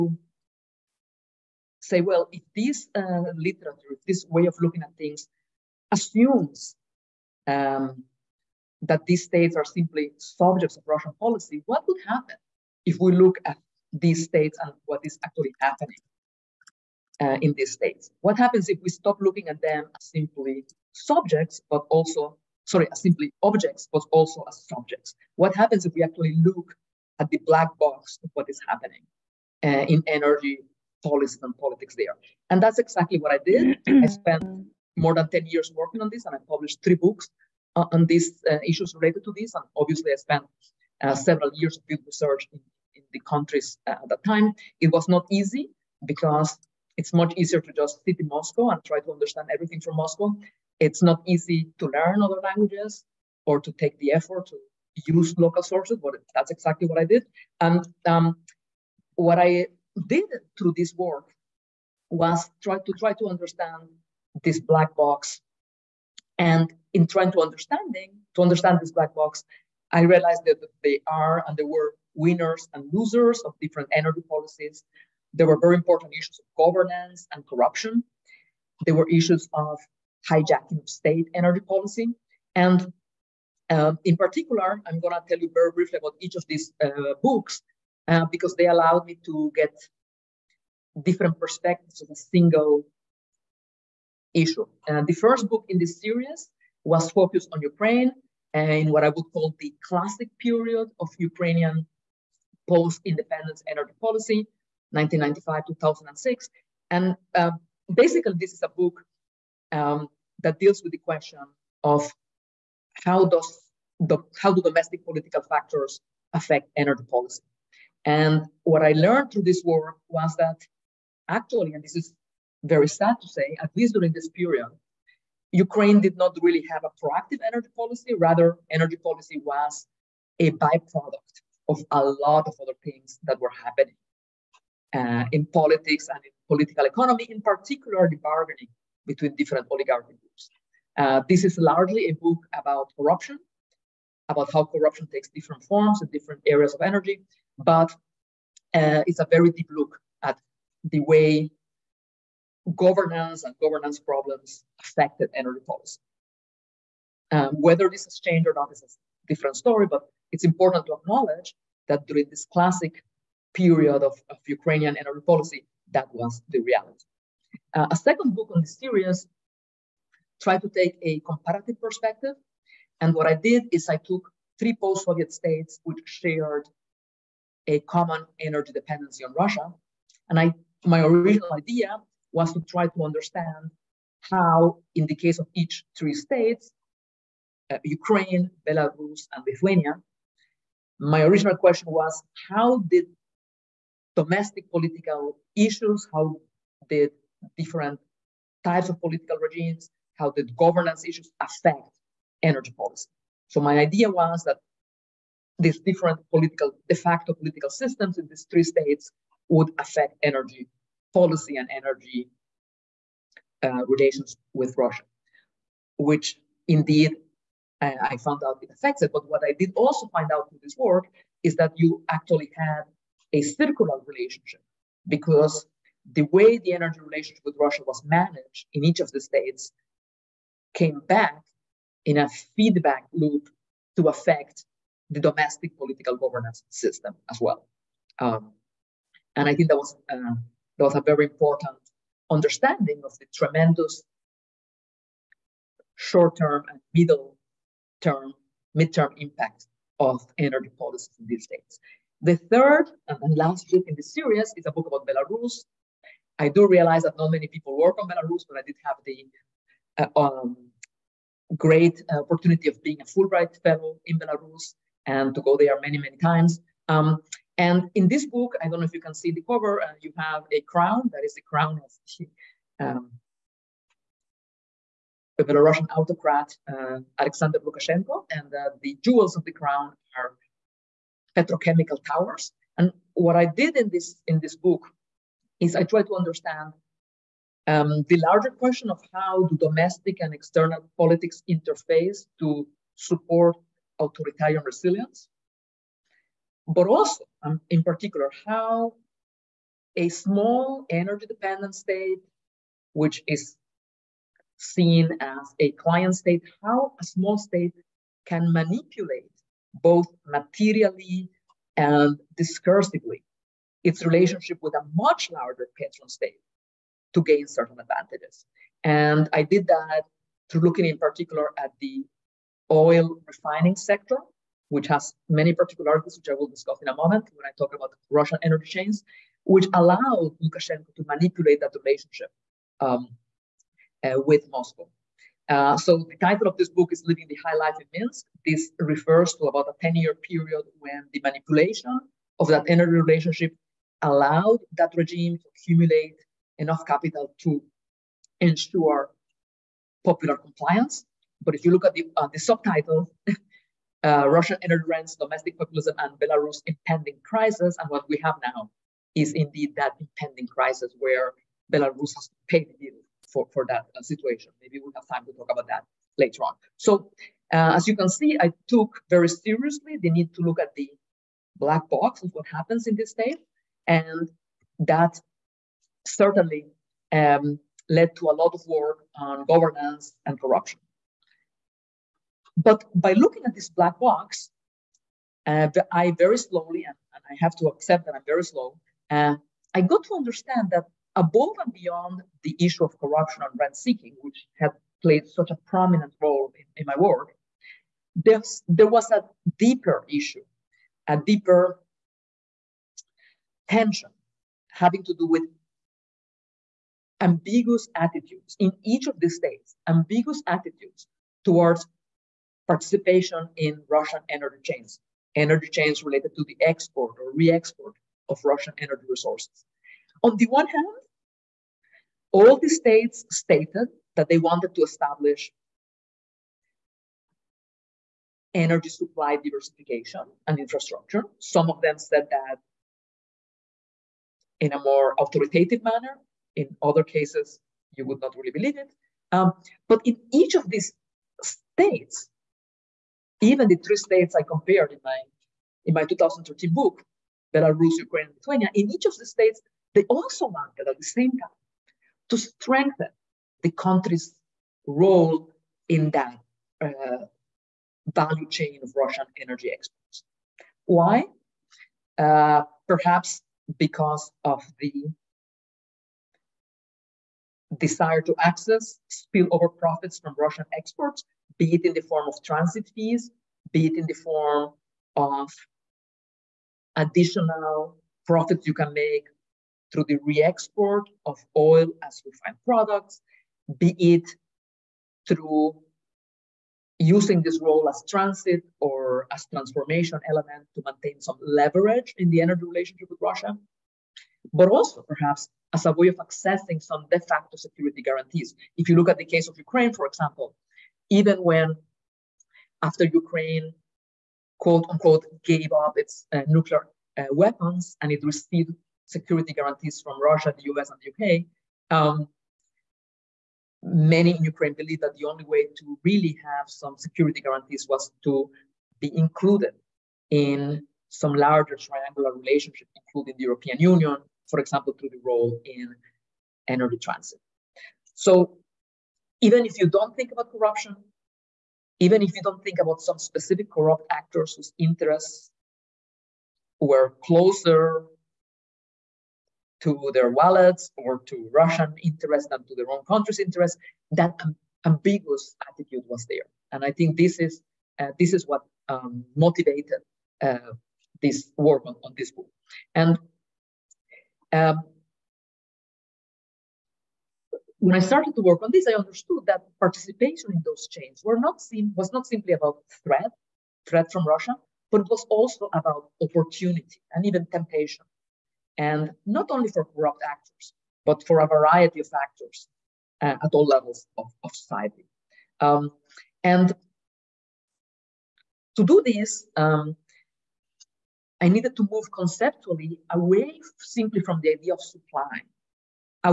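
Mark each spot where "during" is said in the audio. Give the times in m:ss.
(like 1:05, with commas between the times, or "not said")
2:03, 2:42.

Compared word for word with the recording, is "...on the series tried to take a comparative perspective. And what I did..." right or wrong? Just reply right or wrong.
right.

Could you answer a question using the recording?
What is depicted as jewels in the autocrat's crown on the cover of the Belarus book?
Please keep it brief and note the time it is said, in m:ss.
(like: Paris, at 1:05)
petrochemical towers, at 4:41.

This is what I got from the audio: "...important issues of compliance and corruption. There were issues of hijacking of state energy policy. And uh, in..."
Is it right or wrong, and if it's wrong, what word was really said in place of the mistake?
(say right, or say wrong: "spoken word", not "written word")
wrong: "governance", not "compliance".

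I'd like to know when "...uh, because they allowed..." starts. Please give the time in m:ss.
1:28.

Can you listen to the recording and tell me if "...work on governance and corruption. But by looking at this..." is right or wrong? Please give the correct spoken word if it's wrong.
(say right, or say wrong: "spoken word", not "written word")
right.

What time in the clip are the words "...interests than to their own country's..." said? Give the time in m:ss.
9:02.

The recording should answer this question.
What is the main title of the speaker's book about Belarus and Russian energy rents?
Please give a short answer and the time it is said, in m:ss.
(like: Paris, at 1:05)
Living the High Life in Minsk, at 5:37.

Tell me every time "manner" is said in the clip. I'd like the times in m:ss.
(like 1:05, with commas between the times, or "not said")
7:15.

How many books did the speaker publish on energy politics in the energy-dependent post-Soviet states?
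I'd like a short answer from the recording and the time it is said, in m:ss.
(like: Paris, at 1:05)
3, at 0:36.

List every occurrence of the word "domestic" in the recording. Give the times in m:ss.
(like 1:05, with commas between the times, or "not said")
1:54, 3:14, 3:55, 4:49, 5:55.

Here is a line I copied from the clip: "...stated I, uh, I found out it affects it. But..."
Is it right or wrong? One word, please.
wrong.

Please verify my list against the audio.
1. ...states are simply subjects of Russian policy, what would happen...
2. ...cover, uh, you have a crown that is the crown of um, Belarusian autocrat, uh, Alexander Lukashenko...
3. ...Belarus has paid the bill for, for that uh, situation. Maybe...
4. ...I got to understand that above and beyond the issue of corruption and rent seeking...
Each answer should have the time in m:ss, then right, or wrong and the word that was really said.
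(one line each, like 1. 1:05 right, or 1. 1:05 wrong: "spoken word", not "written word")
1. 0:09 right
2. 4:29 right
3. 6:01 right
4. 6:29 right.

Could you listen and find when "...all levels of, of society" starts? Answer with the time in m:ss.
9:33.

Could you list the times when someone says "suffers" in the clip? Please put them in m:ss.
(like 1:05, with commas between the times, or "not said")
not said.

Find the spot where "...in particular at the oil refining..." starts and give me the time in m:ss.
5:20.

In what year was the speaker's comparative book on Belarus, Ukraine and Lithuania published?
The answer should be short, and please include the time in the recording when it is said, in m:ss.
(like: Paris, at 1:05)
2013, at 7:26.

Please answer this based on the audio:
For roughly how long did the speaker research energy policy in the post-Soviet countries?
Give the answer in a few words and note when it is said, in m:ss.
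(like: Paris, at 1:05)
more than 10 years, at 0:34.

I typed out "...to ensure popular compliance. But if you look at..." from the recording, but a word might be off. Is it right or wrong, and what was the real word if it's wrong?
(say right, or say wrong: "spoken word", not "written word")
right.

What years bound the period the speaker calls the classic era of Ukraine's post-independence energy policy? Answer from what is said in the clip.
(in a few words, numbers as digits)
1995 to 2006.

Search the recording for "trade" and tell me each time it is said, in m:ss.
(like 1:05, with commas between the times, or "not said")
not said.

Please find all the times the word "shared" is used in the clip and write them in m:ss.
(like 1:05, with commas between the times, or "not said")
2:56.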